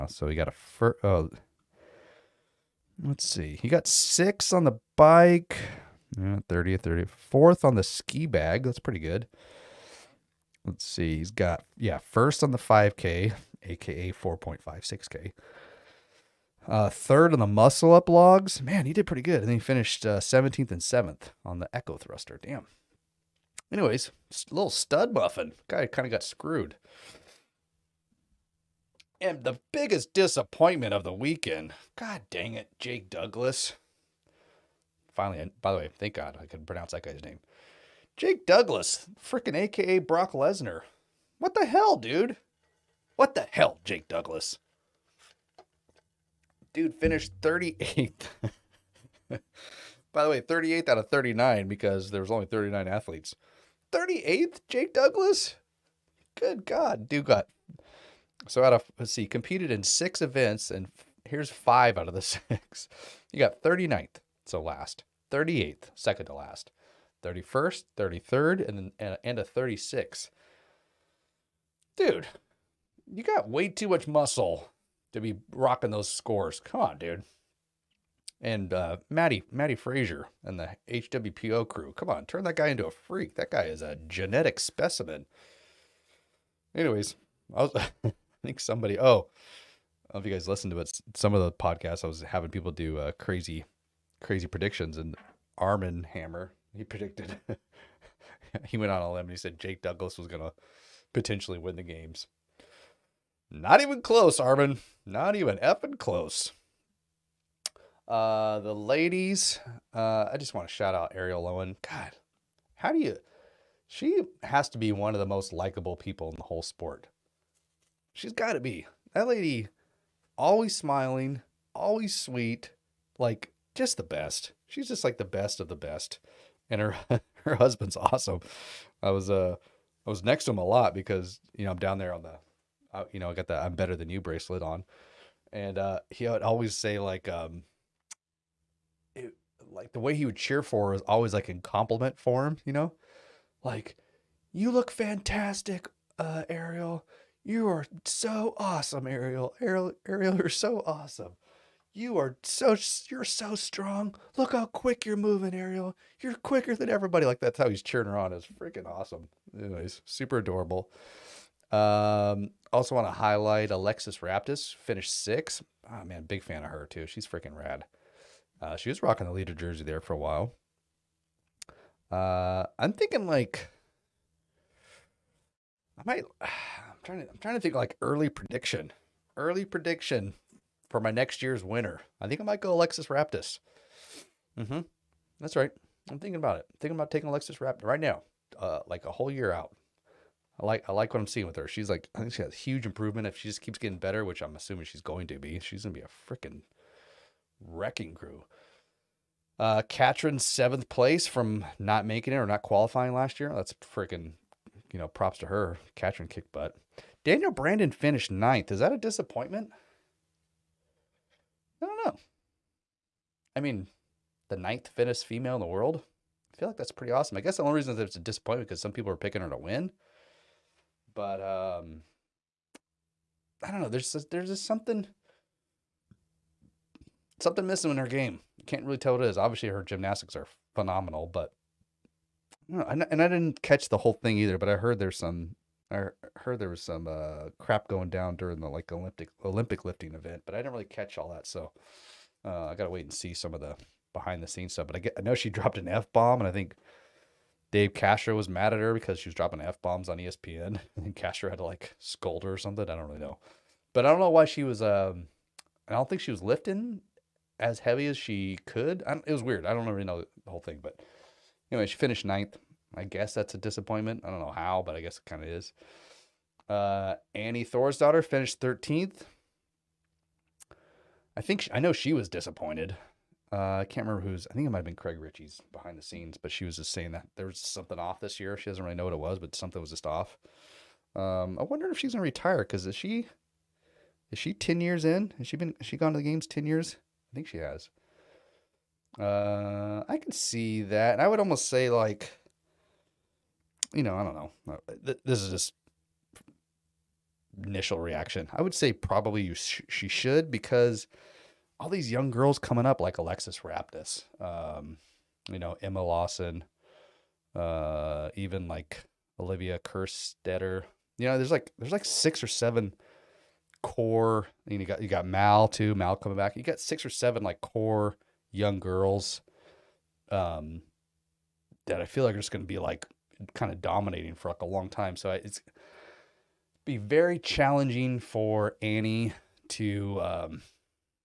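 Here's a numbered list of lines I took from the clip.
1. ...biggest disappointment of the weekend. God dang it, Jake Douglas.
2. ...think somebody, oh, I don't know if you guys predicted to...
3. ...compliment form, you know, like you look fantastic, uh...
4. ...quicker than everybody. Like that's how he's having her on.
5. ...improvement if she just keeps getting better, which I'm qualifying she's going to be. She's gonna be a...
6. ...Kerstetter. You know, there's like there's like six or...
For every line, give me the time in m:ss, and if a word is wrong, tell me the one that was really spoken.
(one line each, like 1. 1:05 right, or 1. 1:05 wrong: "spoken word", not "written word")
1. 0:29 right
2. 1:28 wrong: "listened", not "predicted"
3. 2:21 right
4. 2:36 wrong: "cheering", not "having"
5. 3:12 wrong: "assuming", not "qualifying"
6. 5:09 right.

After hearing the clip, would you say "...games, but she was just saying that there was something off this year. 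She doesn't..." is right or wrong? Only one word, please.
wrong.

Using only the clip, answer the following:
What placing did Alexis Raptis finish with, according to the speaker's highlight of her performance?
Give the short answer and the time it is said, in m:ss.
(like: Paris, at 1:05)
6th, at 2:44.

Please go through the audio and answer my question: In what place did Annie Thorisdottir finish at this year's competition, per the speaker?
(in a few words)
13th.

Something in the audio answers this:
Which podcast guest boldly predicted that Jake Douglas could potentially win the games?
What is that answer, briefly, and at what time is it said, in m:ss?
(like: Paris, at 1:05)
Armin Hammer, at 1:35.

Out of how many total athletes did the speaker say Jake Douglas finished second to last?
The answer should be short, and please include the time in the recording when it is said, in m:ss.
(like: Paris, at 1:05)
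39, at 0:52.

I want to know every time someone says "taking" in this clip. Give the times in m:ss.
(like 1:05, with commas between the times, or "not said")
3:07.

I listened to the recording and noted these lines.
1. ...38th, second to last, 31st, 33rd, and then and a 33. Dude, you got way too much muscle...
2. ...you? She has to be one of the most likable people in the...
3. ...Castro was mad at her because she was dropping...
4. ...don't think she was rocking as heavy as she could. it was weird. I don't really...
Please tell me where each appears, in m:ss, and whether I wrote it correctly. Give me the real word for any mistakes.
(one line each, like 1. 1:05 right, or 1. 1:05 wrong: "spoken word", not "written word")
1. 1:05 wrong: "36", not "33"
2. 1:52 right
3. 4:07 right
4. 4:15 wrong: "lifting", not "rocking".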